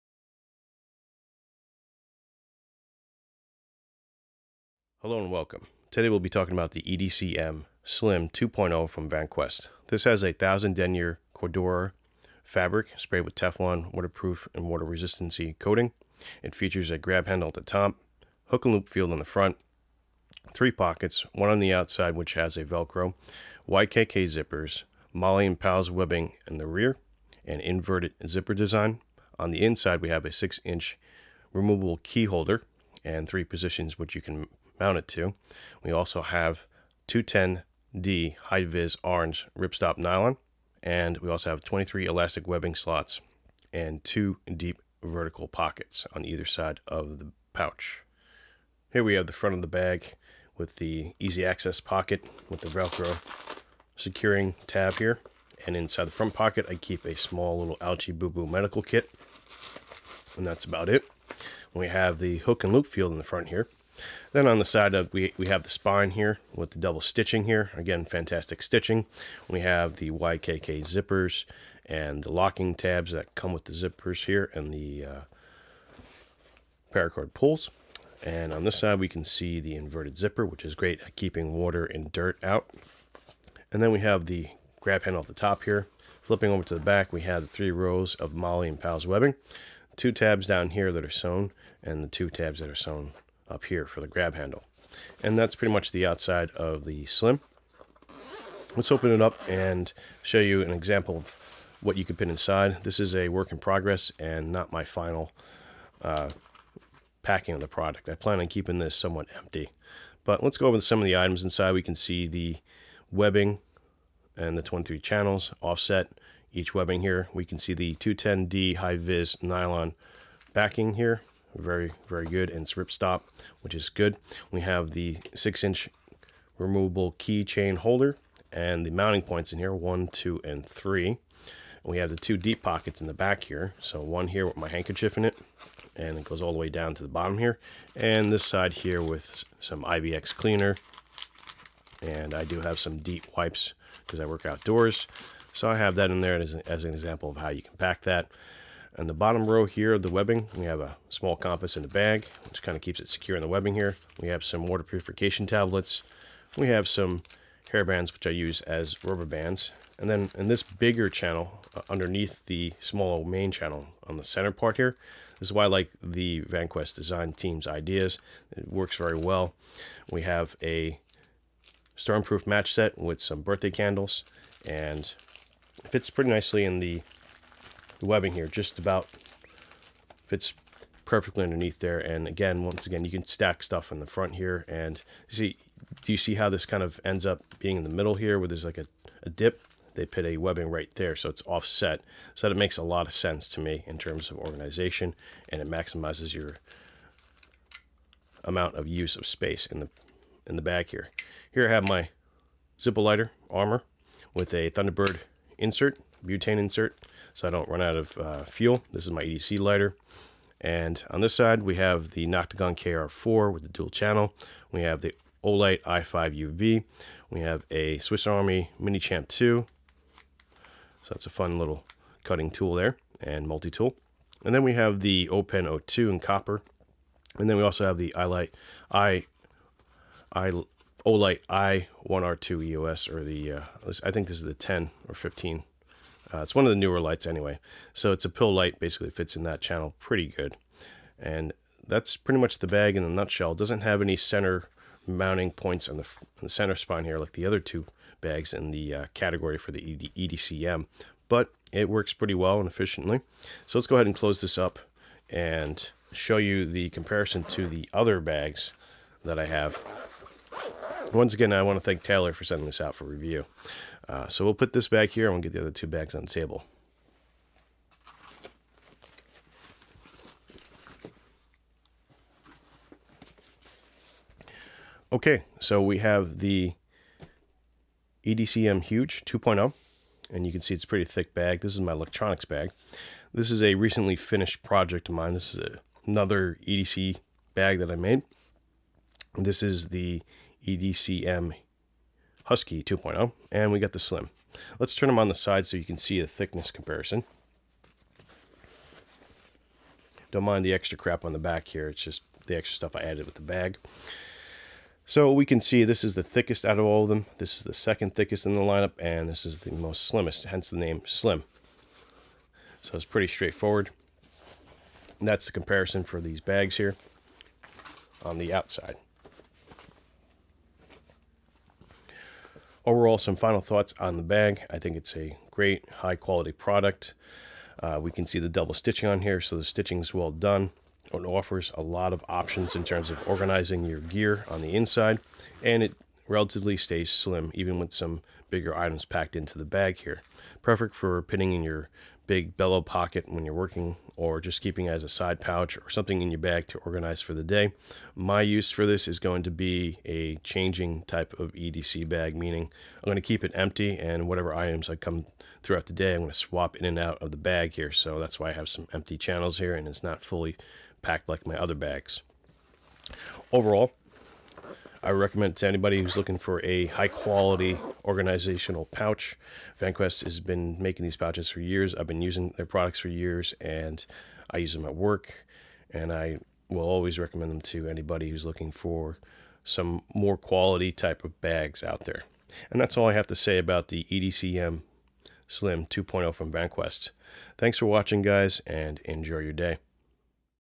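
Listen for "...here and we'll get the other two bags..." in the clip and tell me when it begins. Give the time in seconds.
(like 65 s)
265 s.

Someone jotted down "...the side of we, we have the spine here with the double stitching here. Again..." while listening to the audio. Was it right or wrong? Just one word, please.
right.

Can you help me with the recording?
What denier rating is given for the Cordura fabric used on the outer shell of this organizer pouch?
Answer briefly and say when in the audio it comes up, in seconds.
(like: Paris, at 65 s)
1000, at 10 s.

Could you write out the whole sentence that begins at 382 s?
And that's all I have to say about the EDCM Slim 2.0 from VanQuest.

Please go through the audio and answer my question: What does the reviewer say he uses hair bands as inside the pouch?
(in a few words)
Rubber bands.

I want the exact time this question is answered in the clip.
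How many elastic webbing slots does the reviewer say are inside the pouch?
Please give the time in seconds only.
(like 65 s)
41 s.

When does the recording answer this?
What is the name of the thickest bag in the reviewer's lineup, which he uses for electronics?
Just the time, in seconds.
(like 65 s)
278 s.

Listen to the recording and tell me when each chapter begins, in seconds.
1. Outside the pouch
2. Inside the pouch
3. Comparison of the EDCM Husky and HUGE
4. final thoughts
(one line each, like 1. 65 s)
1. 48 s
2. 96 s
3. 266 s
4. 320 s.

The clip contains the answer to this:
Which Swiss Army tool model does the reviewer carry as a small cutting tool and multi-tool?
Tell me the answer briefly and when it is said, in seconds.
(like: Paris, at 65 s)
Mini Champ 2, at 218 s.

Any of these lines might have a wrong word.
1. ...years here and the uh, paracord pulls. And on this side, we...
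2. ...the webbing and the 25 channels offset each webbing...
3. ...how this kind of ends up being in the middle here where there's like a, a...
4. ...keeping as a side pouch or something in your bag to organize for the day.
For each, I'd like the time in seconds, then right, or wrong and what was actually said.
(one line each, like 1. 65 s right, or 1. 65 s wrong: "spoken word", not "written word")
1. 73 s wrong: "zippers", not "years"
2. 112 s wrong: "23", not "25"
3. 186 s right
4. 344 s right.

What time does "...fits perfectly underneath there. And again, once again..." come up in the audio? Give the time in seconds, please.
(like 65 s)
180 s.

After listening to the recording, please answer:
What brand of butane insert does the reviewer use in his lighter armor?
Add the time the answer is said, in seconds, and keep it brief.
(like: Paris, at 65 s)
Thunderbird, at 204 s.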